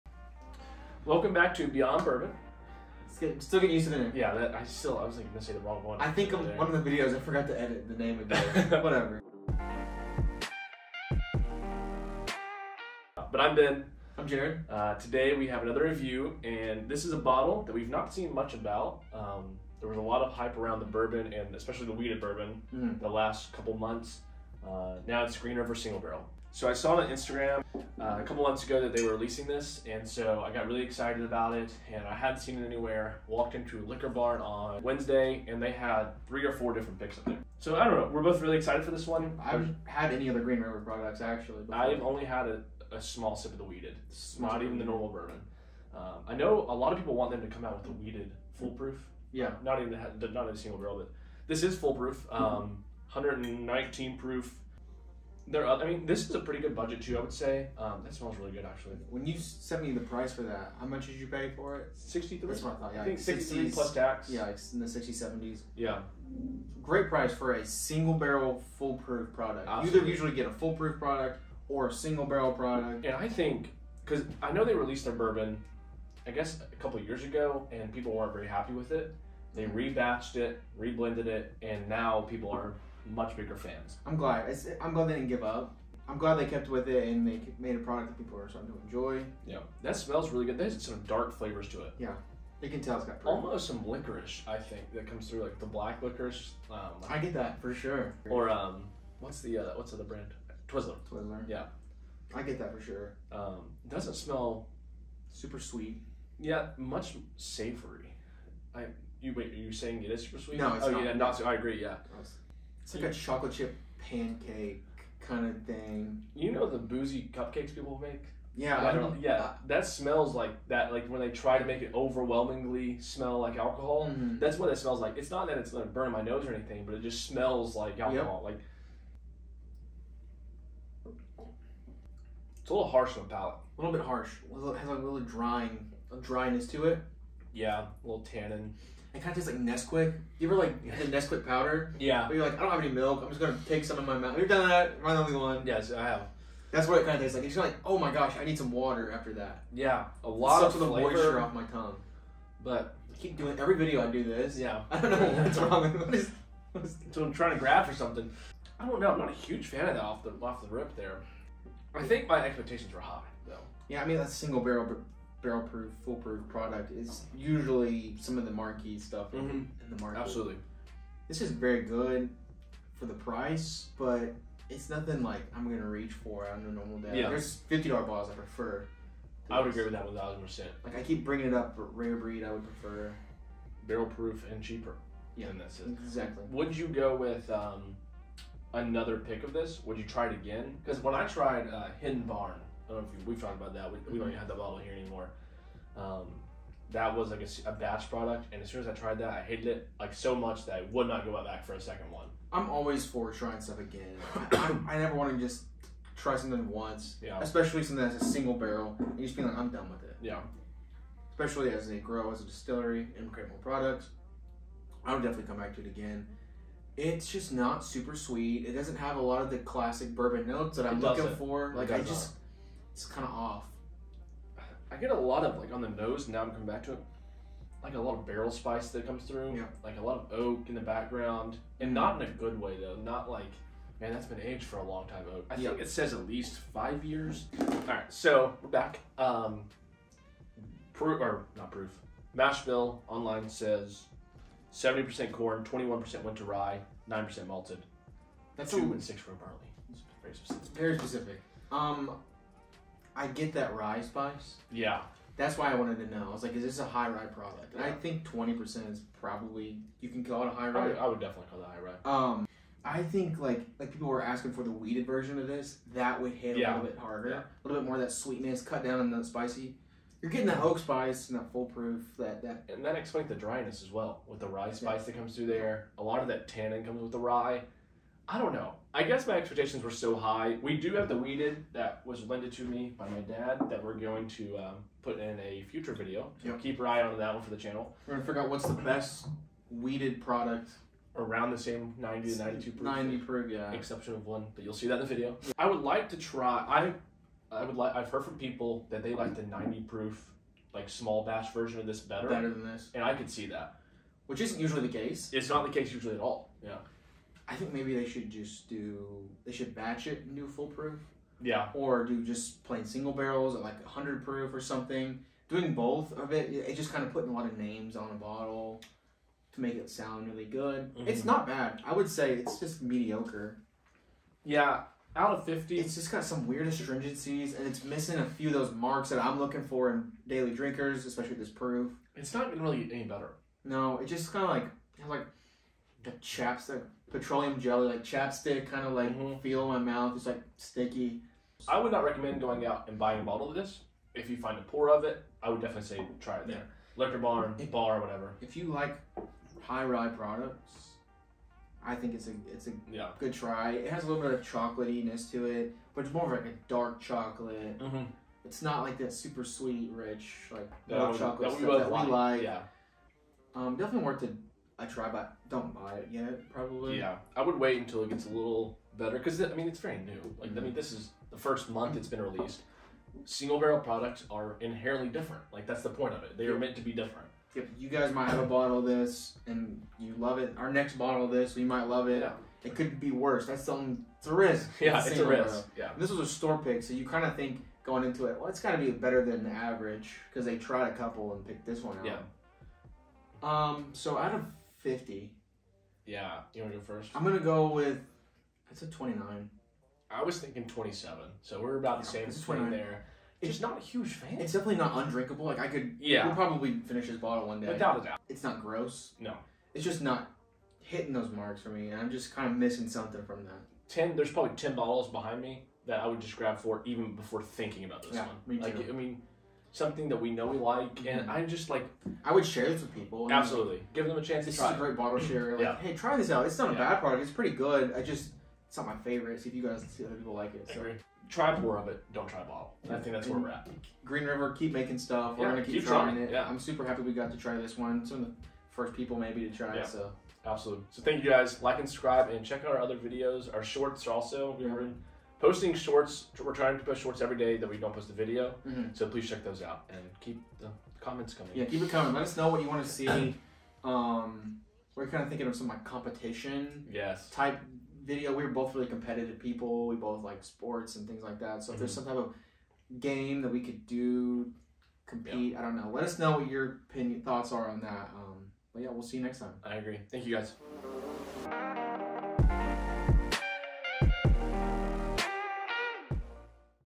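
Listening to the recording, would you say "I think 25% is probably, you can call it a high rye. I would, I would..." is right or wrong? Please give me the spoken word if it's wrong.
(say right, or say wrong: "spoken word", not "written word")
wrong: "20", not "25".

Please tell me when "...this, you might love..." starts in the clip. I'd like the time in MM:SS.
06:21.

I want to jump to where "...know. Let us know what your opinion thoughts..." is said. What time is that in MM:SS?
07:45.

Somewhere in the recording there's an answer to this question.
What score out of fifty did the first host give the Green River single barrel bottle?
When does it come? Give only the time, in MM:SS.
06:38.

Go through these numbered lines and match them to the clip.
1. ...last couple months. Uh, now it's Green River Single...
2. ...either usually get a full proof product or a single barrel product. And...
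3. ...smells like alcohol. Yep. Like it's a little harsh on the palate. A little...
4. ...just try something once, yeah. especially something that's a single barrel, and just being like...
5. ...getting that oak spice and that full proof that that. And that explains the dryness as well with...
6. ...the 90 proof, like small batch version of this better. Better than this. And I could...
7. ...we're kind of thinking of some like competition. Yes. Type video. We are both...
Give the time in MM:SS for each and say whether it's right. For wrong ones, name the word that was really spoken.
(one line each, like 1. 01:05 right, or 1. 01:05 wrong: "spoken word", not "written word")
1. 00:23 right
2. 01:10 right
3. 02:07 right
4. 03:25 right
5. 04:30 right
6. 04:59 right
7. 07:34 right.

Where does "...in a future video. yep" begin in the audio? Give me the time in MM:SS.
04:45.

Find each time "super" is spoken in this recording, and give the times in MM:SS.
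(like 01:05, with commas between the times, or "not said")
01:45, 01:50, 03:37, 05:59, 07:16.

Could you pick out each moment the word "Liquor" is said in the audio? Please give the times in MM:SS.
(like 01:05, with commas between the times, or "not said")
00:33, 05:47.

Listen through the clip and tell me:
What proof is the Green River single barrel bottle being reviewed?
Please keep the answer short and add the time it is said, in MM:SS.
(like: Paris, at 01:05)
119, at 00:53.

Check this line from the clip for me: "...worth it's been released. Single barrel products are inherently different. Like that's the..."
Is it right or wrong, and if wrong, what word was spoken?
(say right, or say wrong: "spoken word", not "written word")
wrong: "month", not "worth".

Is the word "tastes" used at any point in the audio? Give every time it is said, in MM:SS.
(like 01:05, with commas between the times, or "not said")
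02:19, 02:27.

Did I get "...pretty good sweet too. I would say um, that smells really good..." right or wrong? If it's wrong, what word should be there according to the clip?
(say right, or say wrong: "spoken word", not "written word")
wrong: "budget", not "sweet".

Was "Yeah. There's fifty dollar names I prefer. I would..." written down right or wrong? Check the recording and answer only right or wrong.
wrong.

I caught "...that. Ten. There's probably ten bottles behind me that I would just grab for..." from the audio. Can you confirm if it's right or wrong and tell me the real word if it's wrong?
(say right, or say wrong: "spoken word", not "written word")
right.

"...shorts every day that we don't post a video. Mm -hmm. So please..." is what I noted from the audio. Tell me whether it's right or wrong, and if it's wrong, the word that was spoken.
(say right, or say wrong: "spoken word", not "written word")
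right.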